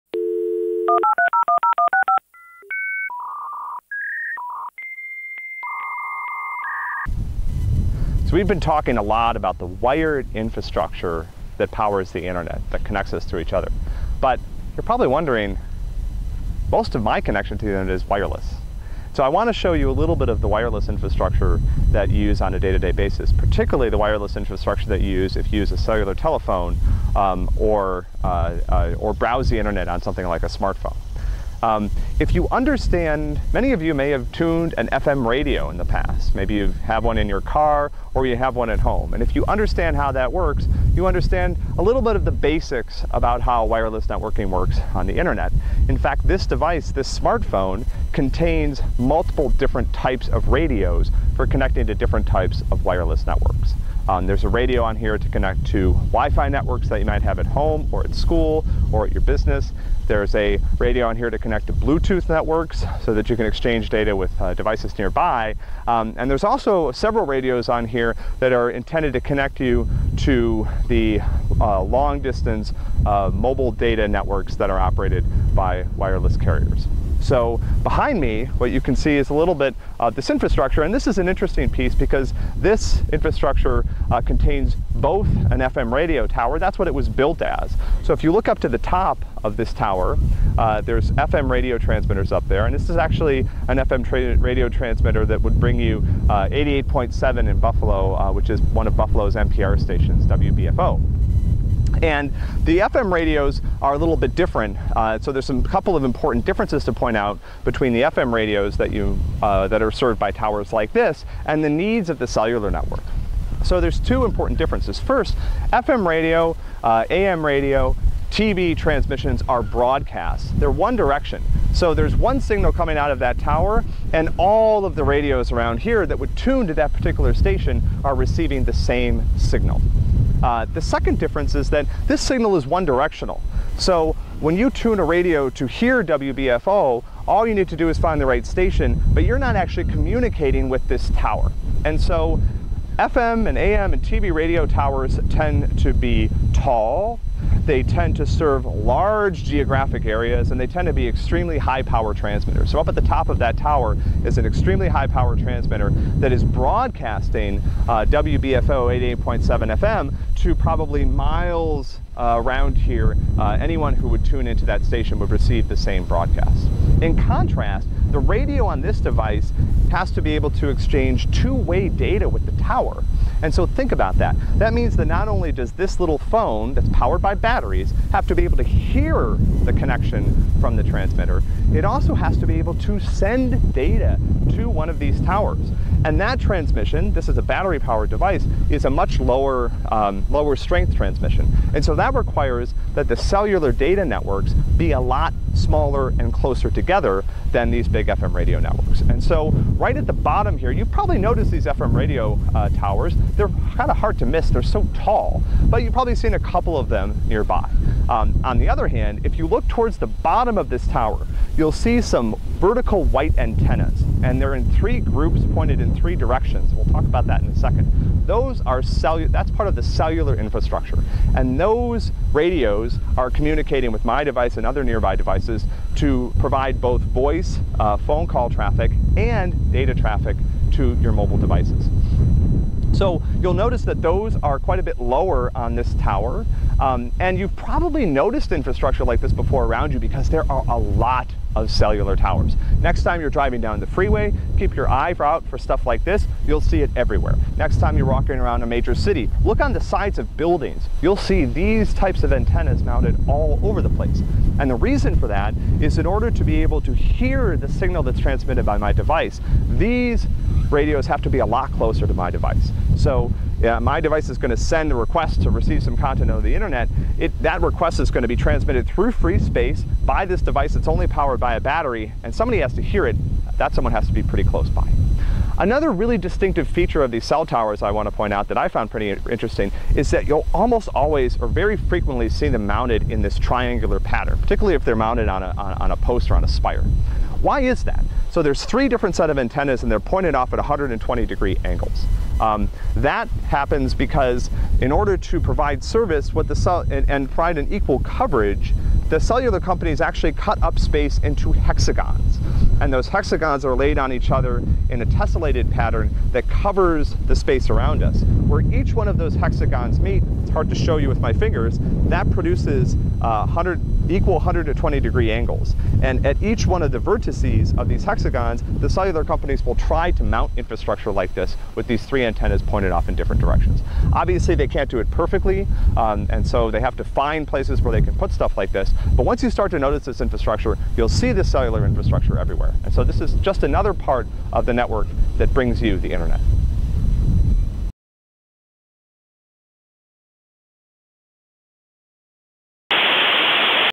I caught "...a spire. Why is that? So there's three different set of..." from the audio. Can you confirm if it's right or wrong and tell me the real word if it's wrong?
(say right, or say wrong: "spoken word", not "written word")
right.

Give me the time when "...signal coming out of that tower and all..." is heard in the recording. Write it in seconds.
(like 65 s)
122 s.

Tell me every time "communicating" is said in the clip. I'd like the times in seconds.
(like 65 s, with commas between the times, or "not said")
139 s, 223 s.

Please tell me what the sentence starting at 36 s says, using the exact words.
Maybe you have one in your car or you have one at home.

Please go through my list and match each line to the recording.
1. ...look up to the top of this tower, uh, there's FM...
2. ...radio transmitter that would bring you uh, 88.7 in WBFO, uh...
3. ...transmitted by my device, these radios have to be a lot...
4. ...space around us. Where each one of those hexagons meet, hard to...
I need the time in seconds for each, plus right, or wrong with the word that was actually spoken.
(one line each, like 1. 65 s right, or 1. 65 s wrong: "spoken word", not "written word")
1. 88 s right
2. 94 s wrong: "Buffalo", not "WBFO"
3. 258 s right
4. 307 s right.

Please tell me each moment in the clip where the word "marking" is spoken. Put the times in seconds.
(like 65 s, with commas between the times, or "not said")
not said.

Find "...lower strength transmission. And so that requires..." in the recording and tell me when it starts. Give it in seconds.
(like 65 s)
190 s.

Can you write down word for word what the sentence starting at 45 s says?
In fact, this device, this smartphone, contains multiple different types of radios for connecting to different types of wireless networks.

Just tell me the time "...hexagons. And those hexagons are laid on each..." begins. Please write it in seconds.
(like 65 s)
301 s.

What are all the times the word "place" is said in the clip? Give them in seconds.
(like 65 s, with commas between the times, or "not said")
253 s, 327 s.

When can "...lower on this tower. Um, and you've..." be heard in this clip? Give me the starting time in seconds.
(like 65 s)
235 s.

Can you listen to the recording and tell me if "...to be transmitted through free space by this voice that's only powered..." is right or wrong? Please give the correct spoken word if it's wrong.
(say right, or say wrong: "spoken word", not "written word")
wrong: "device", not "voice".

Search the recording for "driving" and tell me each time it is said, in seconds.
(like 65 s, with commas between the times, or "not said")
243 s.